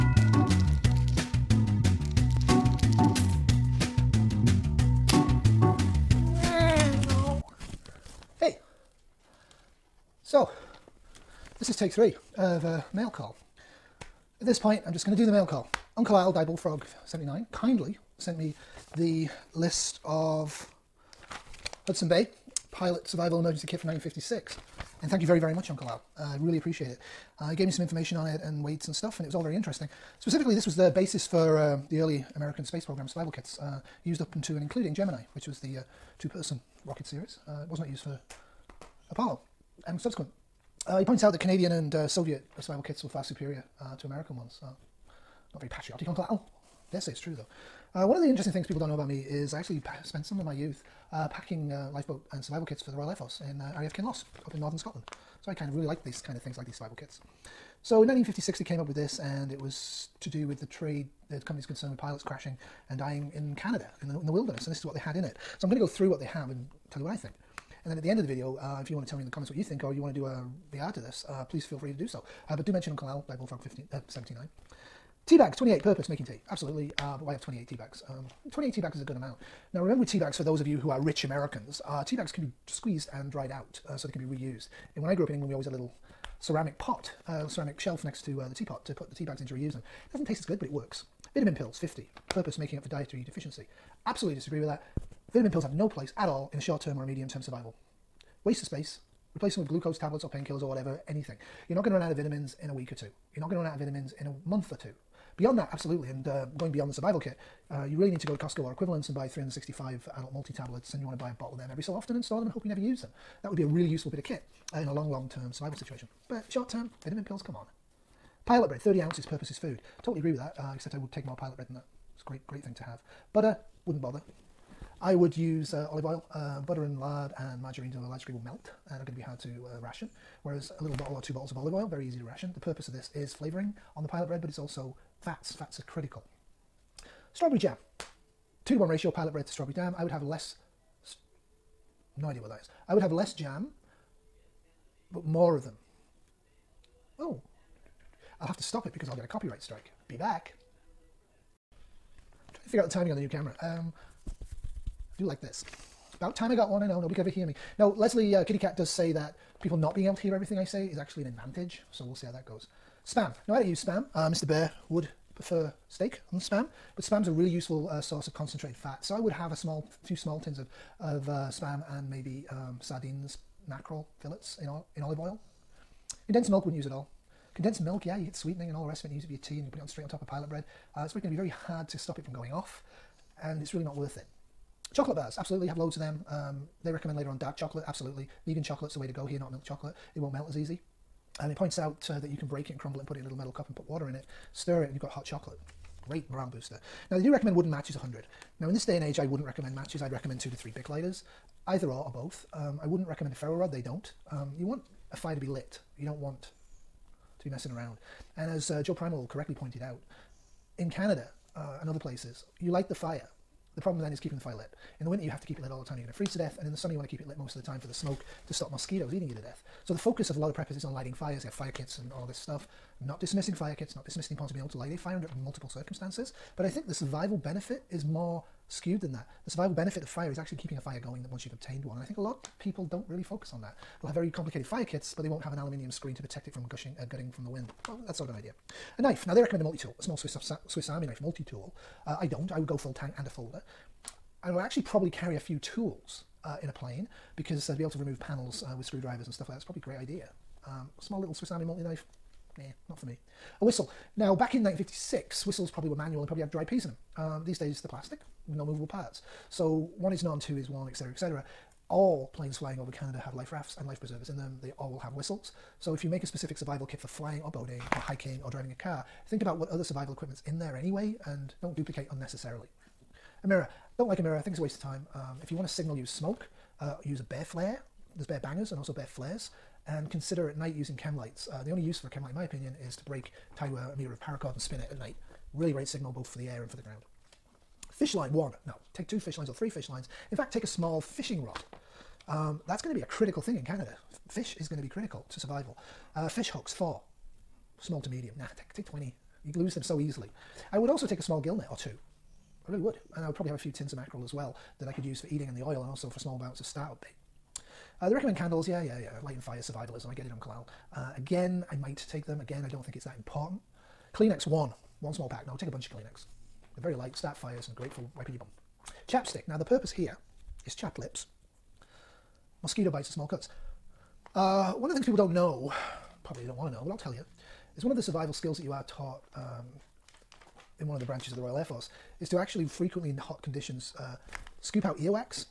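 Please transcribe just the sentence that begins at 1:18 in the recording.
Um, 28 teabags is a good amount.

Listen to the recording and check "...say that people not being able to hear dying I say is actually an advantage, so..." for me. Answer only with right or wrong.
wrong.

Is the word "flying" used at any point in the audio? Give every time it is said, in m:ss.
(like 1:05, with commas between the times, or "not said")
4:22, 4:27.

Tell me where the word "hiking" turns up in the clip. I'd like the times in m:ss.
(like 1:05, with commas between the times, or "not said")
4:27.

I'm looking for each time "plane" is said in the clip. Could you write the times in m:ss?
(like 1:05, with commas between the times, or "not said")
4:06, 4:22.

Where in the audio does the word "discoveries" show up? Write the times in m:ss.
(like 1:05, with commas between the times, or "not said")
not said.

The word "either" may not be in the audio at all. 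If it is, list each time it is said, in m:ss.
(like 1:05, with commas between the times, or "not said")
3:21.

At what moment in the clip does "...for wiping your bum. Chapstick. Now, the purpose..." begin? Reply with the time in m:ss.
5:17.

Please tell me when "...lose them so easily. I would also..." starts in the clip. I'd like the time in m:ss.
4:59.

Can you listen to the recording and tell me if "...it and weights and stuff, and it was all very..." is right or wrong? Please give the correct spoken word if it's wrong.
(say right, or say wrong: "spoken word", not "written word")
right.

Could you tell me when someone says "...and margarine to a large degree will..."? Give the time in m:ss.
2:07.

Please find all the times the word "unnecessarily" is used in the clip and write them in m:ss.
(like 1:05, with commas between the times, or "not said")
4:32.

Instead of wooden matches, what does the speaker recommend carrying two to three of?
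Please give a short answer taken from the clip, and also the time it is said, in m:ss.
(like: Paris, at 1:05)
Bic lighters, at 3:20.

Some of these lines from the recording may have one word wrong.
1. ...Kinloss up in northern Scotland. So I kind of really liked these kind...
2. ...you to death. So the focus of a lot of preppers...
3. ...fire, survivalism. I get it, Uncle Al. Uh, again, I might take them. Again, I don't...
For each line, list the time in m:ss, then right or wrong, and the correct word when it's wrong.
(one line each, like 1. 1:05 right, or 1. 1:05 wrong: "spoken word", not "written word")
1. 0:53 right
2. 3:39 right
3. 5:09 right.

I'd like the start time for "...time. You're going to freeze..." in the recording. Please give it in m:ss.
3:35.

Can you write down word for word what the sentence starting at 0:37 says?
Uh, it was not used for Apollo and subsequent.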